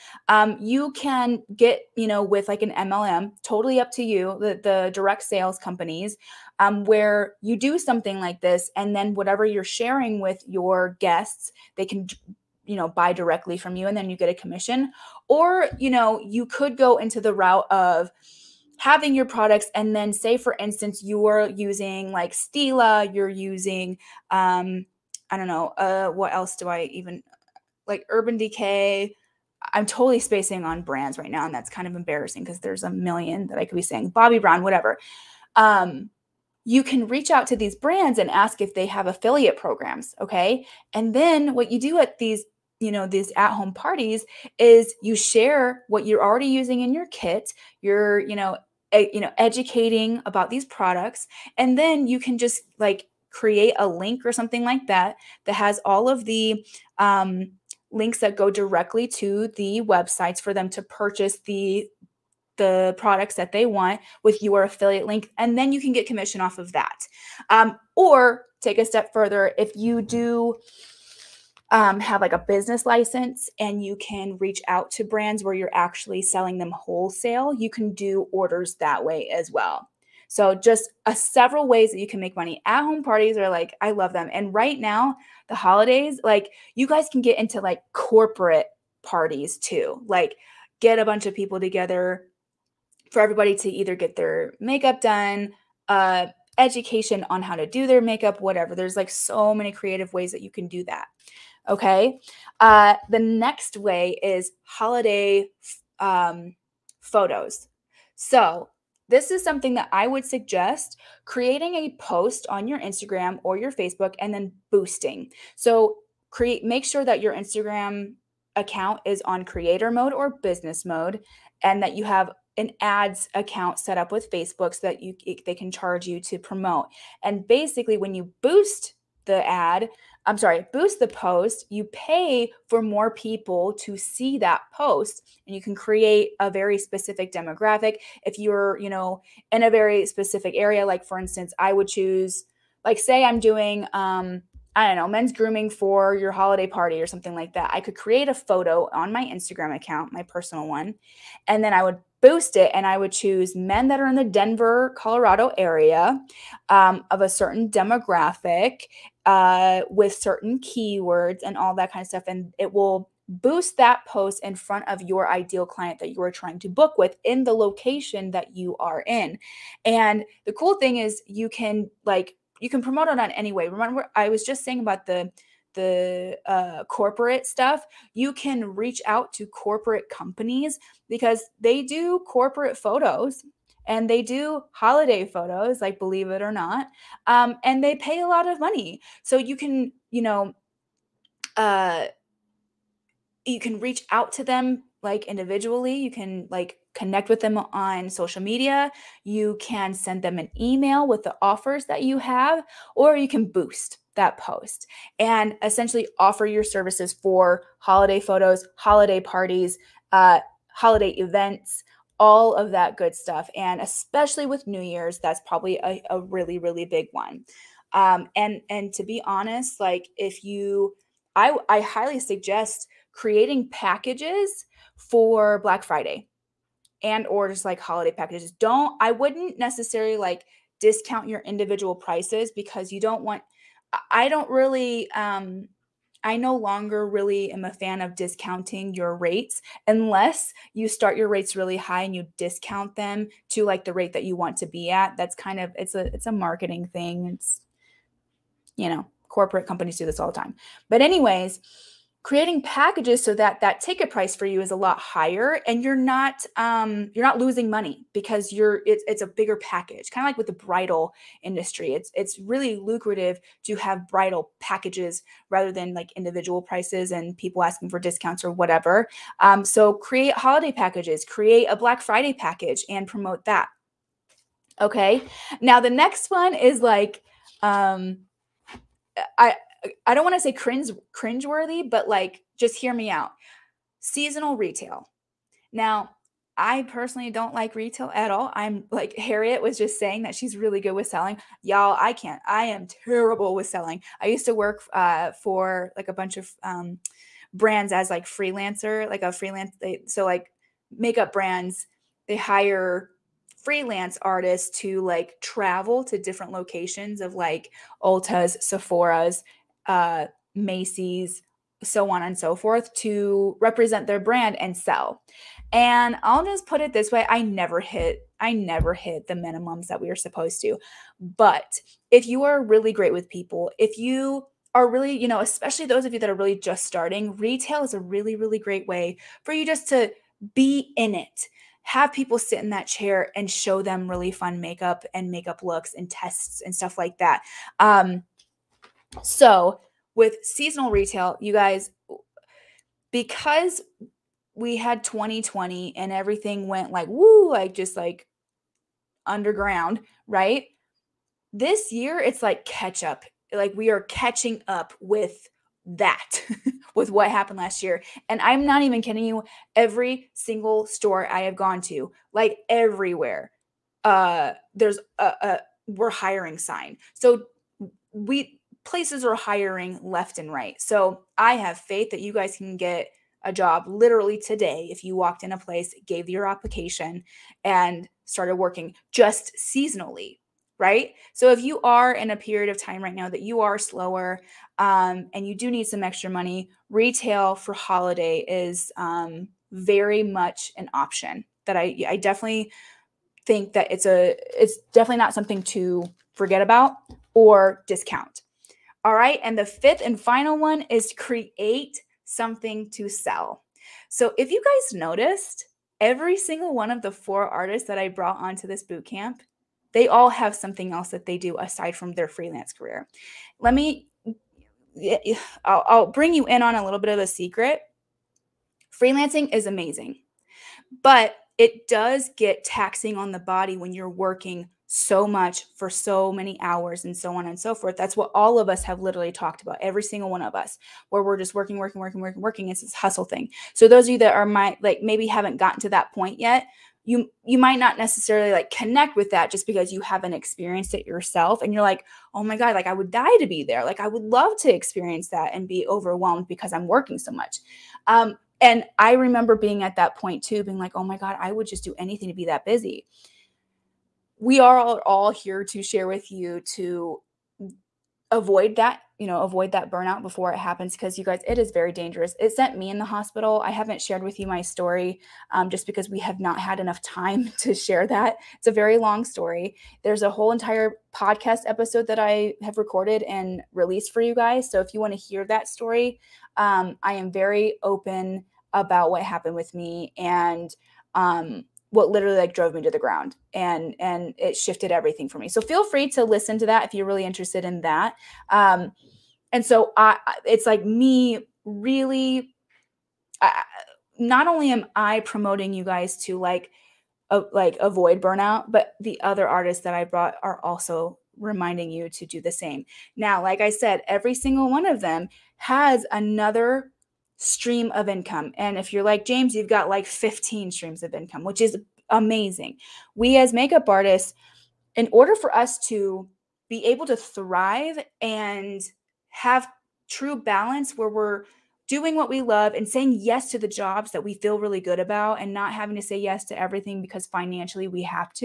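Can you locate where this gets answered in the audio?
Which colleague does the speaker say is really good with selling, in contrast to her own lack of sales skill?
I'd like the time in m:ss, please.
4:49.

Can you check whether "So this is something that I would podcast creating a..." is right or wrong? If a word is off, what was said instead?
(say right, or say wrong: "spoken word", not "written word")
wrong: "suggest", not "podcast".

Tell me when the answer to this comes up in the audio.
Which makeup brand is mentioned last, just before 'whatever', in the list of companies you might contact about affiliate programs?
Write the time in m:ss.
0:34.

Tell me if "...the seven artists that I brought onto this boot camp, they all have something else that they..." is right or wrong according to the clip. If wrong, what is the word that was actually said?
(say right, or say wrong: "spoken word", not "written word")
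wrong: "four", not "seven".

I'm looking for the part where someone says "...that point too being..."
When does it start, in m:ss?
7:29.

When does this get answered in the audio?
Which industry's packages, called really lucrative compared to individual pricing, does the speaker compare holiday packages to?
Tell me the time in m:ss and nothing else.
4:20.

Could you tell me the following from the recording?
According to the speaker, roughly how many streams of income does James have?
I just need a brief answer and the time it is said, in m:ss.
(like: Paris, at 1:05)
15, at 8:30.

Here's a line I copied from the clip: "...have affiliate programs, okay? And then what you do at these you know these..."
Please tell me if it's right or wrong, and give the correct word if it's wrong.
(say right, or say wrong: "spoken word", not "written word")
right.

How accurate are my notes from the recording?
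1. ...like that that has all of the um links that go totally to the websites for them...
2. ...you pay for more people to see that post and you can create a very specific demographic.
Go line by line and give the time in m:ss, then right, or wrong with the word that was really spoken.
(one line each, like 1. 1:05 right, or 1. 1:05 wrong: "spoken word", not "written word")
1. 0:54 wrong: "directly", not "totally"
2. 2:11 right.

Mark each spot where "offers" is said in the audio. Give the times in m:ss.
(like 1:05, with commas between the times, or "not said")
3:21, 3:26.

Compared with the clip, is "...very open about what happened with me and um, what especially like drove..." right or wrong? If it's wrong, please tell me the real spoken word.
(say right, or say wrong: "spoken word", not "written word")
wrong: "literally", not "especially".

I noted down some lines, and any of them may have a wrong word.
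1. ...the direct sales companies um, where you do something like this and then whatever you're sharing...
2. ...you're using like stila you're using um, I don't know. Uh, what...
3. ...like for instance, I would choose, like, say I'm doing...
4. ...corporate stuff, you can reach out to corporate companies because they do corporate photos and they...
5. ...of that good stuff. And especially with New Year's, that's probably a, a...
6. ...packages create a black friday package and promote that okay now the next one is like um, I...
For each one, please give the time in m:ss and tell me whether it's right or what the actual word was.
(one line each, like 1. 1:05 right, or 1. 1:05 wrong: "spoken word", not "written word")
1. 0:04 right
2. 0:21 right
3. 2:20 right
4. 2:56 right
5. 3:32 right
6. 4:30 right.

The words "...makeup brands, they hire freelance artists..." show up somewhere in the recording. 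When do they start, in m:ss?
5:00.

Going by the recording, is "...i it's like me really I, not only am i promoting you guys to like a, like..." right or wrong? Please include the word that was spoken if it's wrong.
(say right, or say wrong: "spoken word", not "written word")
right.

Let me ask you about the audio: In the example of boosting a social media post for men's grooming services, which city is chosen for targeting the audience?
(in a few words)
Denver, Colorado.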